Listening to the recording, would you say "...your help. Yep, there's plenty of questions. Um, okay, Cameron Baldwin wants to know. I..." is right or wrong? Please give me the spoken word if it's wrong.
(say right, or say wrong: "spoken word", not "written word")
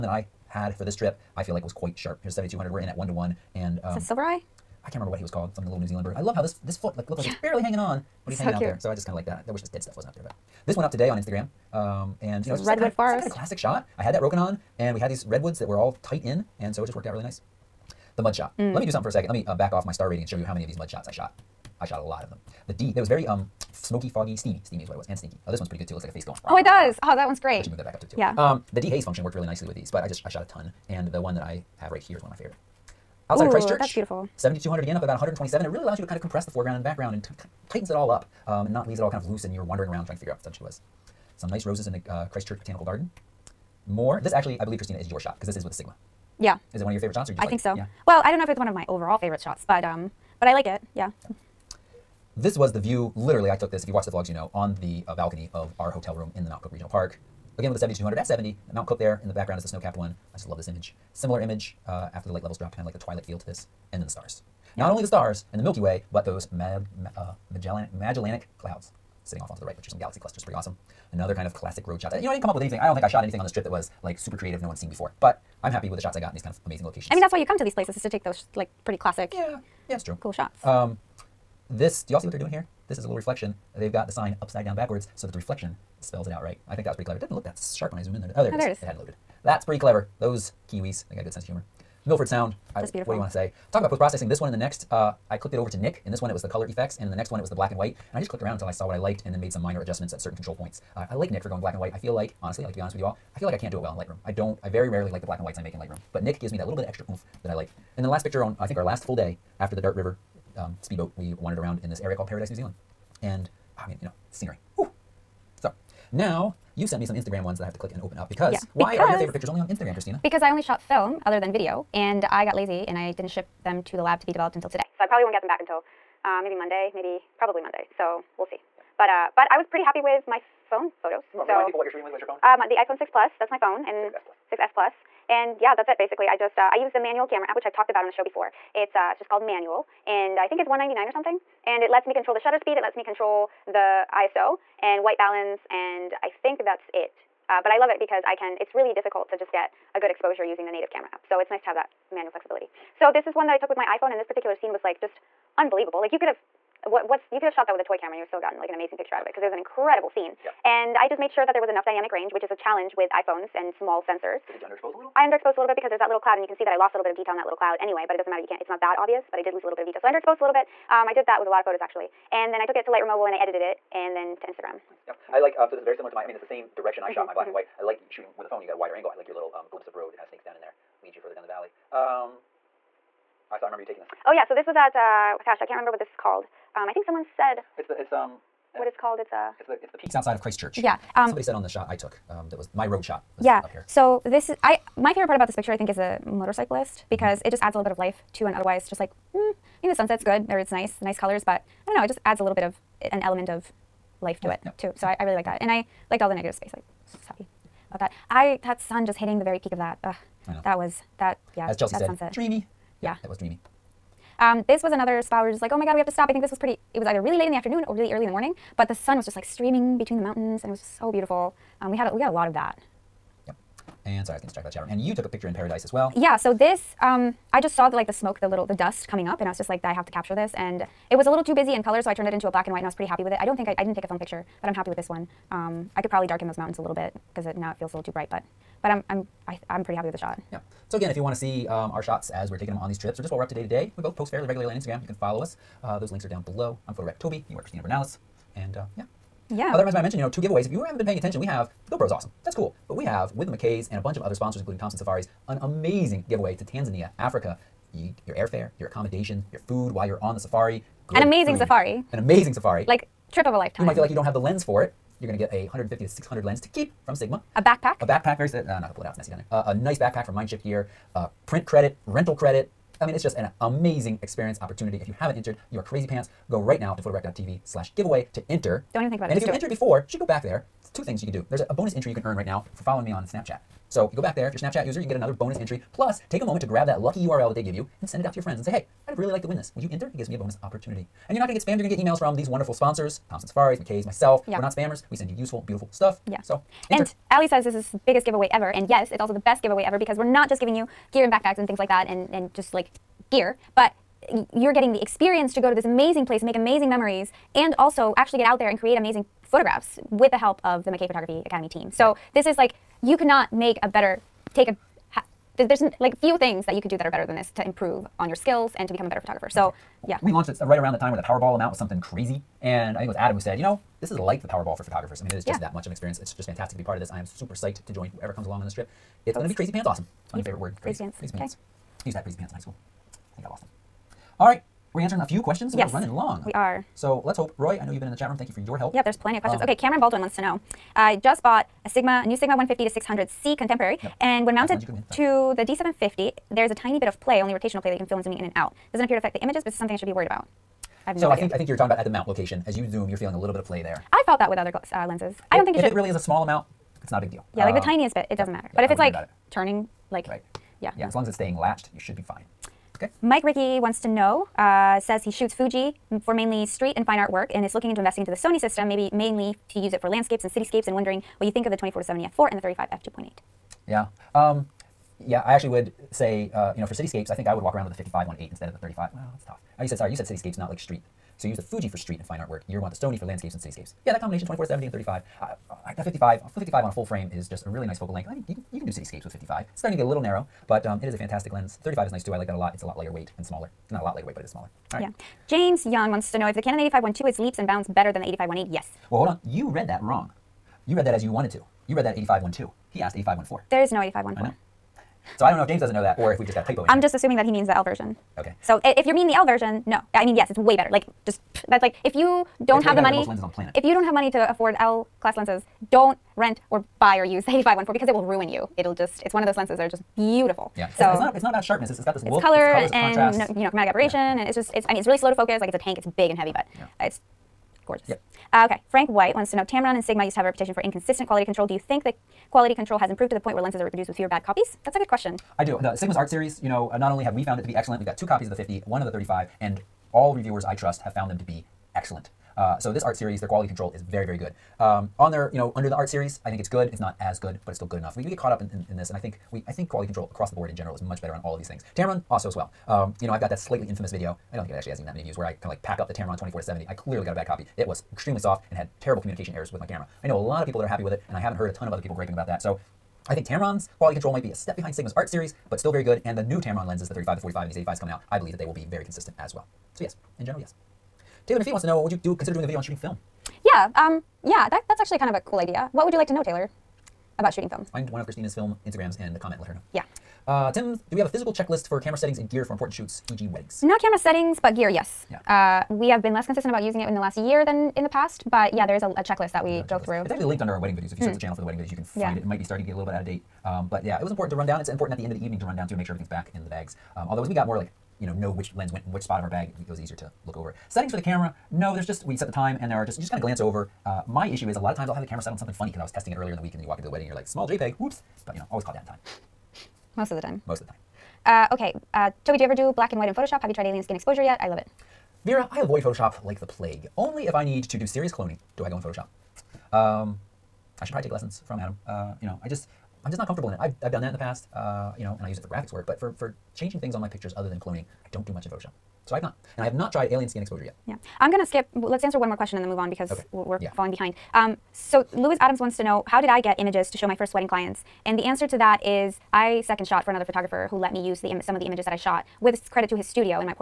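right.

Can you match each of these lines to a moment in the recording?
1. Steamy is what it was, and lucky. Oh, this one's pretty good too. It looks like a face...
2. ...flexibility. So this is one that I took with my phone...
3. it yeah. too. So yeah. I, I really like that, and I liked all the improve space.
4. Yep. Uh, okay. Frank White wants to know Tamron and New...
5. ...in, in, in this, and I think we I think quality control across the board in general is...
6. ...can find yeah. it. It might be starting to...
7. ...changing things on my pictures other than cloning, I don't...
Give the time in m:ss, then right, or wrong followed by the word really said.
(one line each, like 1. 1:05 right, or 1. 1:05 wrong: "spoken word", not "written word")
1. 0:24 wrong: "stinky", not "lucky"
2. 2:32 wrong: "iPhone", not "phone"
3. 3:24 wrong: "negative", not "improve"
4. 7:08 wrong: "Sigma", not "New"
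5. 7:28 right
6. 8:11 right
7. 8:46 right.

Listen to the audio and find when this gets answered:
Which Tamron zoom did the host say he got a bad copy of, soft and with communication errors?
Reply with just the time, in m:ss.
7:36.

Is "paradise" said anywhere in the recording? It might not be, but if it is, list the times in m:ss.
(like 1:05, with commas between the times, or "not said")
1:52, 3:45.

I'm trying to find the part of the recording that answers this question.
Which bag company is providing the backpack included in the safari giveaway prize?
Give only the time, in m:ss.
4:30.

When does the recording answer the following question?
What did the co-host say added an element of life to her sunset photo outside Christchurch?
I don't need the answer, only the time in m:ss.
3:16.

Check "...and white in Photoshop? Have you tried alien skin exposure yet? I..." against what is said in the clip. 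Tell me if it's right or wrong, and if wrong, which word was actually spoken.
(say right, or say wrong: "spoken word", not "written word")
right.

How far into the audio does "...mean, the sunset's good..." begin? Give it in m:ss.
3:19.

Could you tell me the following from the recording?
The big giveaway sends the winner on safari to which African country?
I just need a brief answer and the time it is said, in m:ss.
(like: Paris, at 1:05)
Tanzania, at 4:16.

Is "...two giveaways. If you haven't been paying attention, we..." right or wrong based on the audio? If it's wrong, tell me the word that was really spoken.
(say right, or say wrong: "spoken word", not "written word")
right.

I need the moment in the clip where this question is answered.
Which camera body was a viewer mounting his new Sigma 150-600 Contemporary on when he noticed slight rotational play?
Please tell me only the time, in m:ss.
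5:45.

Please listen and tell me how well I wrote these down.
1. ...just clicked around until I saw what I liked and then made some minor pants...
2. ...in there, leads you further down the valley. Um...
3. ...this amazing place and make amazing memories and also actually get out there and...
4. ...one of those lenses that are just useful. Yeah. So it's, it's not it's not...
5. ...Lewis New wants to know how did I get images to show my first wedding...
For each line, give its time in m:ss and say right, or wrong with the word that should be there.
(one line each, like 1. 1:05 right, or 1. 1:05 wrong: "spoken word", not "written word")
1. 1:38 wrong: "adjustments", not "pants"
2. 3:00 right
3. 5:05 right
4. 6:59 wrong: "beautiful", not "useful"
5. 8:55 wrong: "Adams", not "New".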